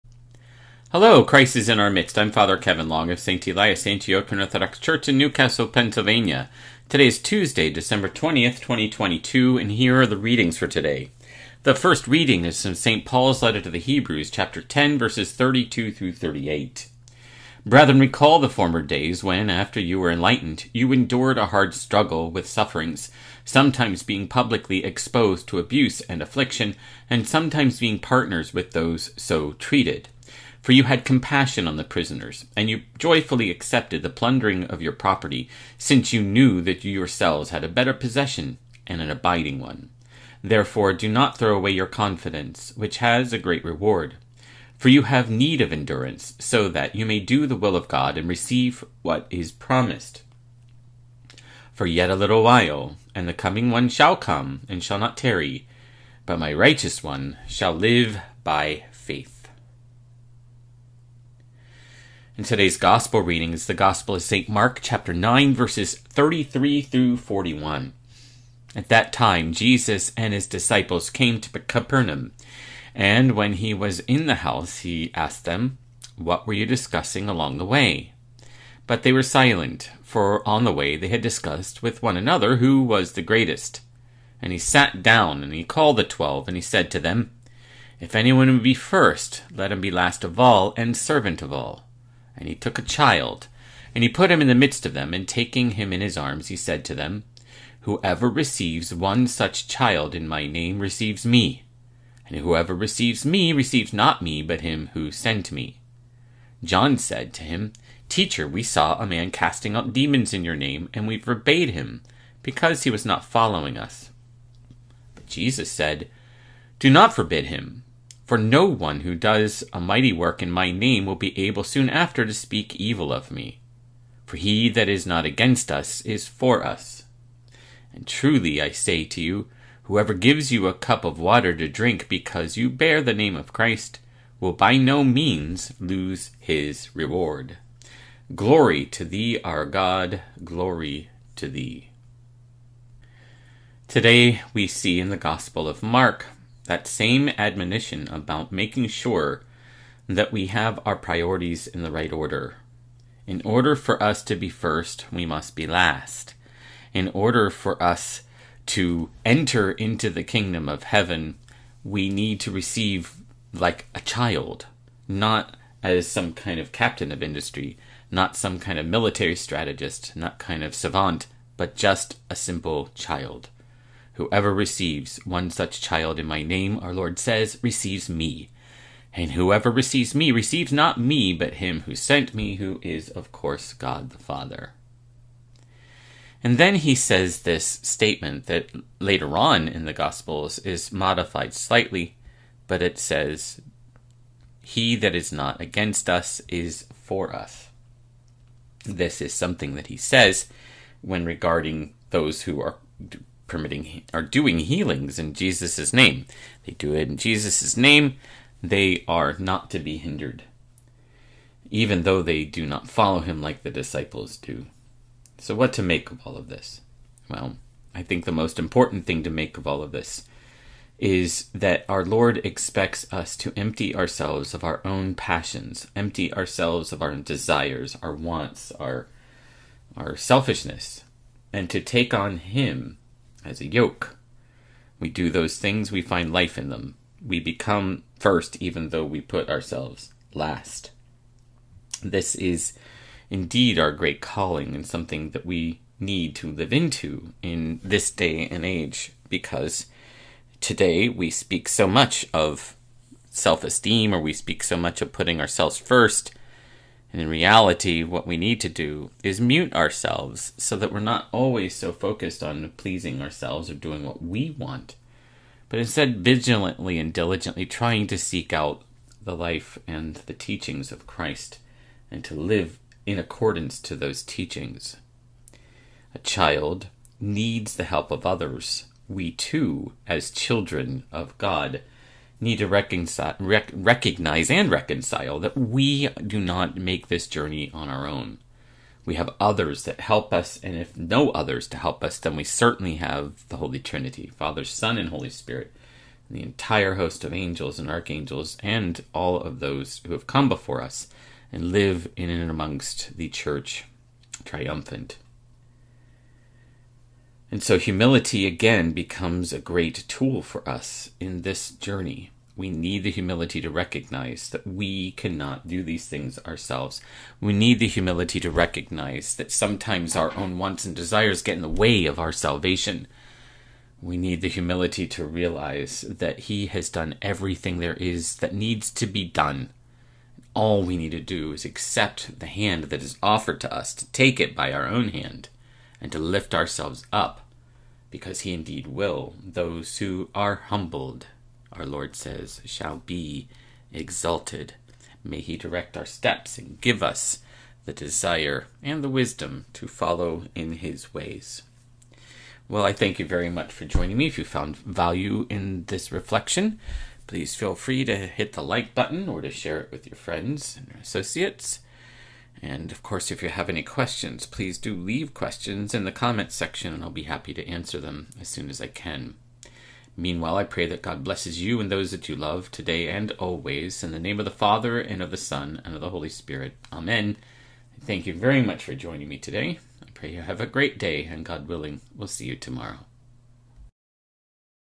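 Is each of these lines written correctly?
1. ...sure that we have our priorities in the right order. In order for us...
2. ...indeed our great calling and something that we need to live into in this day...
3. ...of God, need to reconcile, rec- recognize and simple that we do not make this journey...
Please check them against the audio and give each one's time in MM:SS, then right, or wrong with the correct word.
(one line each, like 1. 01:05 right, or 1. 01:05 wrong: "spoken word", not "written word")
1. 02:28 right
2. 04:03 right
3. 04:41 wrong: "reconcile", not "simple".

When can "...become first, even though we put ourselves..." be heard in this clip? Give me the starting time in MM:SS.
03:57.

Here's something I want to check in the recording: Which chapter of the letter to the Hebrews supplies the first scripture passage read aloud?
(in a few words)
10.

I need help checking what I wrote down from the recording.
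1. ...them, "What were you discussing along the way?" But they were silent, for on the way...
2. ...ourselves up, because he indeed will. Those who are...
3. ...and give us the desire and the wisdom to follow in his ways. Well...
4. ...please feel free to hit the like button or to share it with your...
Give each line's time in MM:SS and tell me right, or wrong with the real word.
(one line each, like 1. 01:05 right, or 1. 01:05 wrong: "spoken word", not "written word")
1. 01:15 right
2. 05:36 right
3. 05:46 right
4. 05:57 right.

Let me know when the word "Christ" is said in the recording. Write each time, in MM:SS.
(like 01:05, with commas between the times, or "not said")
00:01, 02:13, 04:31.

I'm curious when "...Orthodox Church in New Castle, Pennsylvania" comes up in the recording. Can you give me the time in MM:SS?
00:04.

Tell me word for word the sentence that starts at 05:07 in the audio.
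And so humility again becomes a great tool for us in this journey.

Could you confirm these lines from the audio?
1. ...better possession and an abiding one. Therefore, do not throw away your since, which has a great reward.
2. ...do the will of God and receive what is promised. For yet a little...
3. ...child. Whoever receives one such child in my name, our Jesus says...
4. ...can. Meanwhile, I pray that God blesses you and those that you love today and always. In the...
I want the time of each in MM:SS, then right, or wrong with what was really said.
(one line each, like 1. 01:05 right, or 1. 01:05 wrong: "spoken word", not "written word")
1. 00:37 wrong: "confidence", not "since"
2. 00:47 right
3. 02:52 wrong: "Lord", not "Jesus"
4. 06:08 right.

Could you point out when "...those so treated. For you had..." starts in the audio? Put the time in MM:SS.
00:28.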